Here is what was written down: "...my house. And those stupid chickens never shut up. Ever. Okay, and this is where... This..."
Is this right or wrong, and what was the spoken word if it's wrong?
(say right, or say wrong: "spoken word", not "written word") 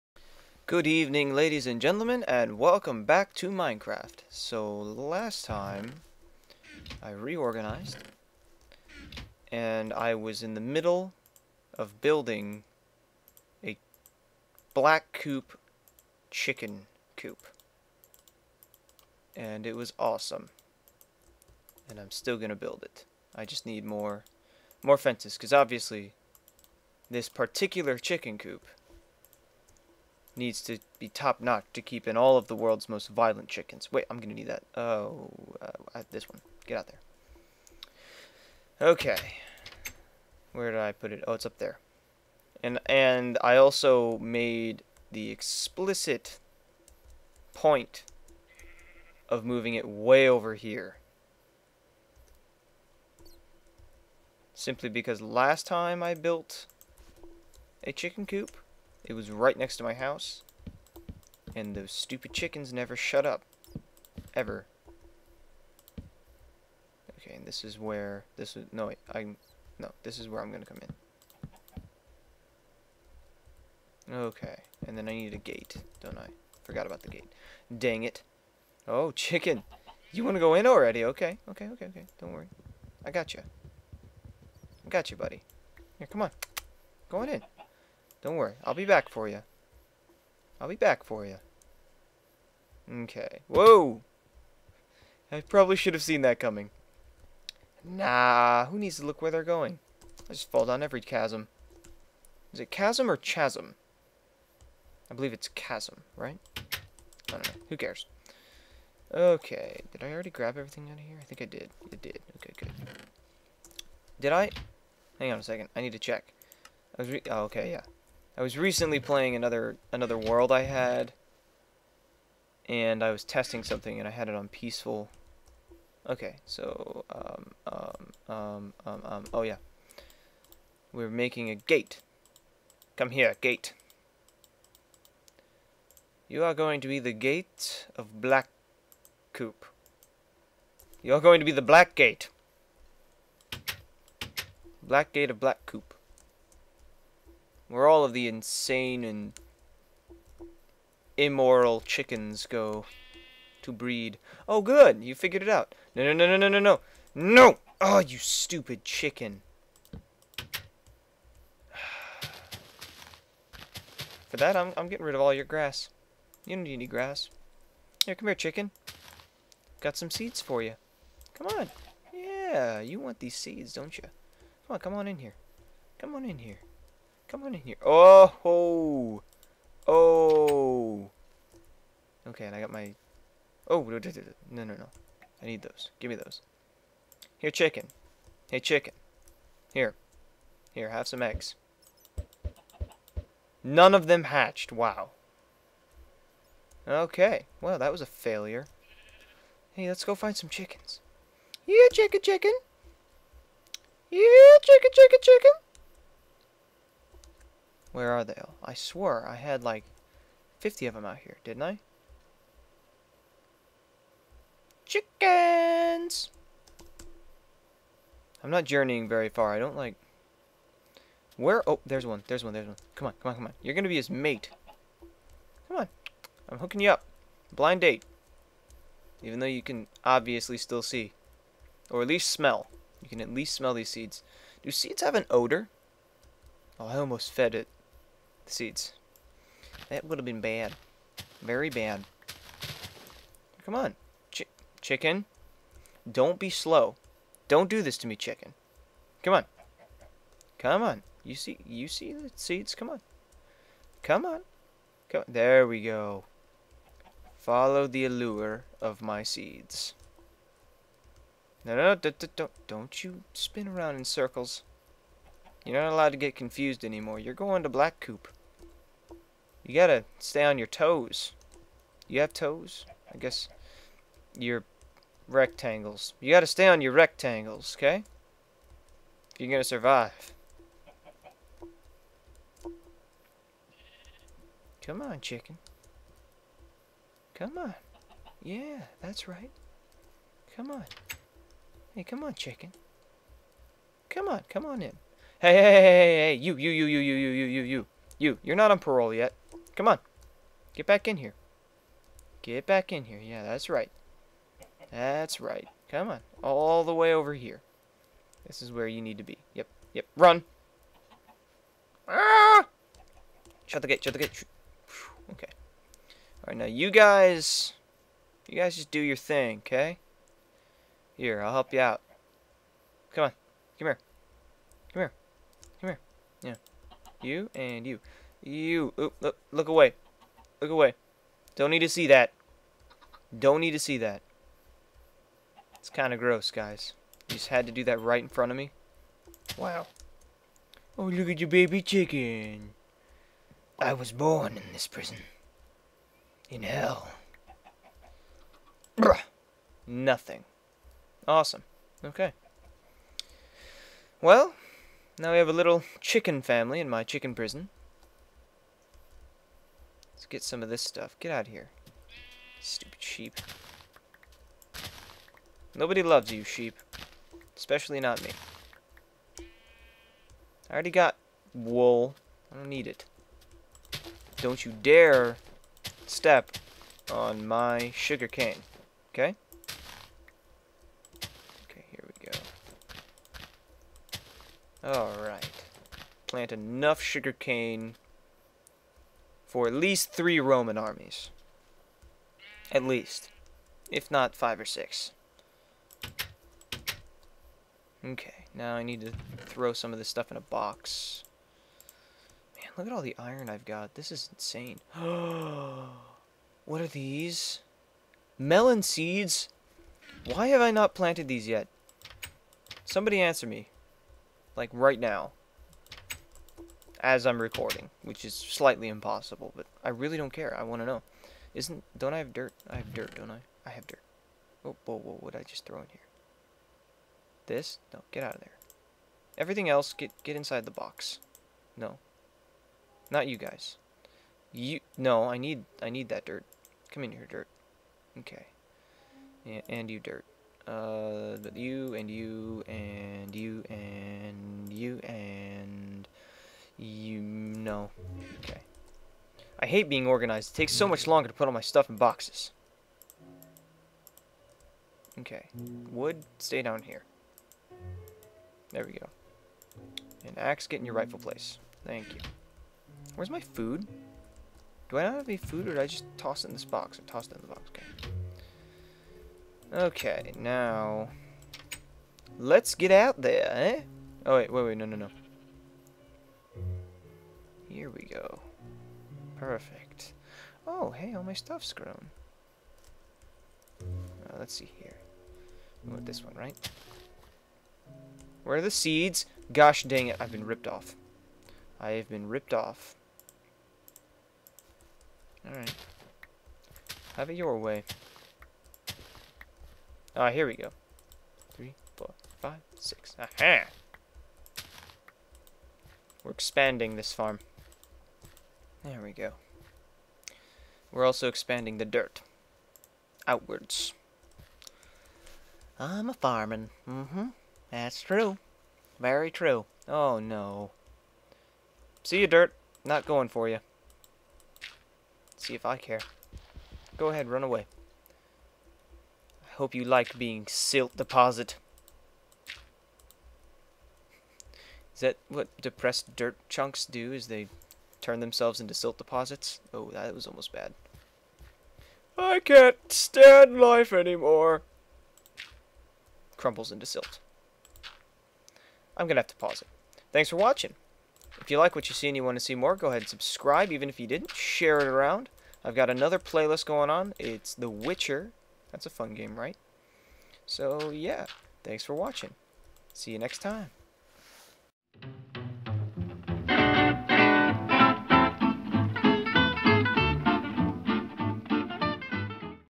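right.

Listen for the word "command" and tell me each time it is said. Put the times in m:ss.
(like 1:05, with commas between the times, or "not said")
not said.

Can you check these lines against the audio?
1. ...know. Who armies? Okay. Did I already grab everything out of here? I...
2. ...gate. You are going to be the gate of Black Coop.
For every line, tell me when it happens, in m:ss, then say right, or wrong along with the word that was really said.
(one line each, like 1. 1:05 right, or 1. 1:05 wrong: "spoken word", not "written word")
1. 1:47 wrong: "cares", not "armies"
2. 2:13 right.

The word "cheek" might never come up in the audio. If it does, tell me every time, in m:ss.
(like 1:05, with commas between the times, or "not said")
not said.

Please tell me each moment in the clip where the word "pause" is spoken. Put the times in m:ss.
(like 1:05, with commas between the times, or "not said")
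9:09.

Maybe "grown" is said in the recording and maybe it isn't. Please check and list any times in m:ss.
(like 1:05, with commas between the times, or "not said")
8:01.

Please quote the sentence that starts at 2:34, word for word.
Oh, good, you figured it out.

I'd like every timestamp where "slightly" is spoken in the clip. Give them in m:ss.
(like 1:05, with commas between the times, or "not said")
6:58.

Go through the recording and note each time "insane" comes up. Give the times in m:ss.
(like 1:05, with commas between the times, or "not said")
2:28, 6:44.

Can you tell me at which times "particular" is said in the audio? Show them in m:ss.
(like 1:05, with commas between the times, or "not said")
0:27.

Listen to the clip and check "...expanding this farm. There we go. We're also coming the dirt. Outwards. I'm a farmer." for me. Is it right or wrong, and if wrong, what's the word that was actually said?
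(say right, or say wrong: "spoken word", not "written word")
wrong: "expanding", not "coming".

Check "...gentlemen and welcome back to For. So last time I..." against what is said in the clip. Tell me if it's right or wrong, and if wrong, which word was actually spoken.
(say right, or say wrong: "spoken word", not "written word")
wrong: "Minecraft", not "For".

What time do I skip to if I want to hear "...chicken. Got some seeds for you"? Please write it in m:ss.
2:48.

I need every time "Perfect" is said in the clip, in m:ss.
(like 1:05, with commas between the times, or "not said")
7:59.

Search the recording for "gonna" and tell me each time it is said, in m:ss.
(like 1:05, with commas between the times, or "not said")
0:22, 0:34, 4:39.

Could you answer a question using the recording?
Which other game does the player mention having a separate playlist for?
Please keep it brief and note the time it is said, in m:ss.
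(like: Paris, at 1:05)
The Witcher, at 9:17.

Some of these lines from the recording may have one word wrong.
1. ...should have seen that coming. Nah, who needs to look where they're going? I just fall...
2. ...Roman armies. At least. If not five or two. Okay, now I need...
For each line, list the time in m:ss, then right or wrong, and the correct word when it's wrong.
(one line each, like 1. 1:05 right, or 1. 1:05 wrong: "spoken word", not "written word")
1. 1:35 right
2. 6:30 wrong: "six", not "two".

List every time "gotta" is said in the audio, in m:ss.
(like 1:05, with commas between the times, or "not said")
4:29, 4:36.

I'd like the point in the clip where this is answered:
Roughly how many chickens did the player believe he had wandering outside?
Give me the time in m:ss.
3:30.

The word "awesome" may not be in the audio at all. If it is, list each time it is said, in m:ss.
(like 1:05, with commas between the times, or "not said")
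0:19, 5:51.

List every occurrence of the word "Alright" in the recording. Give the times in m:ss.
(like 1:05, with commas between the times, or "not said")
6:24, 8:15.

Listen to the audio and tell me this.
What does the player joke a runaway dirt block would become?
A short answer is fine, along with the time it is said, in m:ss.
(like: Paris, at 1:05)
silt deposit, at 8:50.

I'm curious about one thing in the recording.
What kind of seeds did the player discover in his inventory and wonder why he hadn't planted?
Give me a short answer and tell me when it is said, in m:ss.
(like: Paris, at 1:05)
Melon seeds, at 6:48.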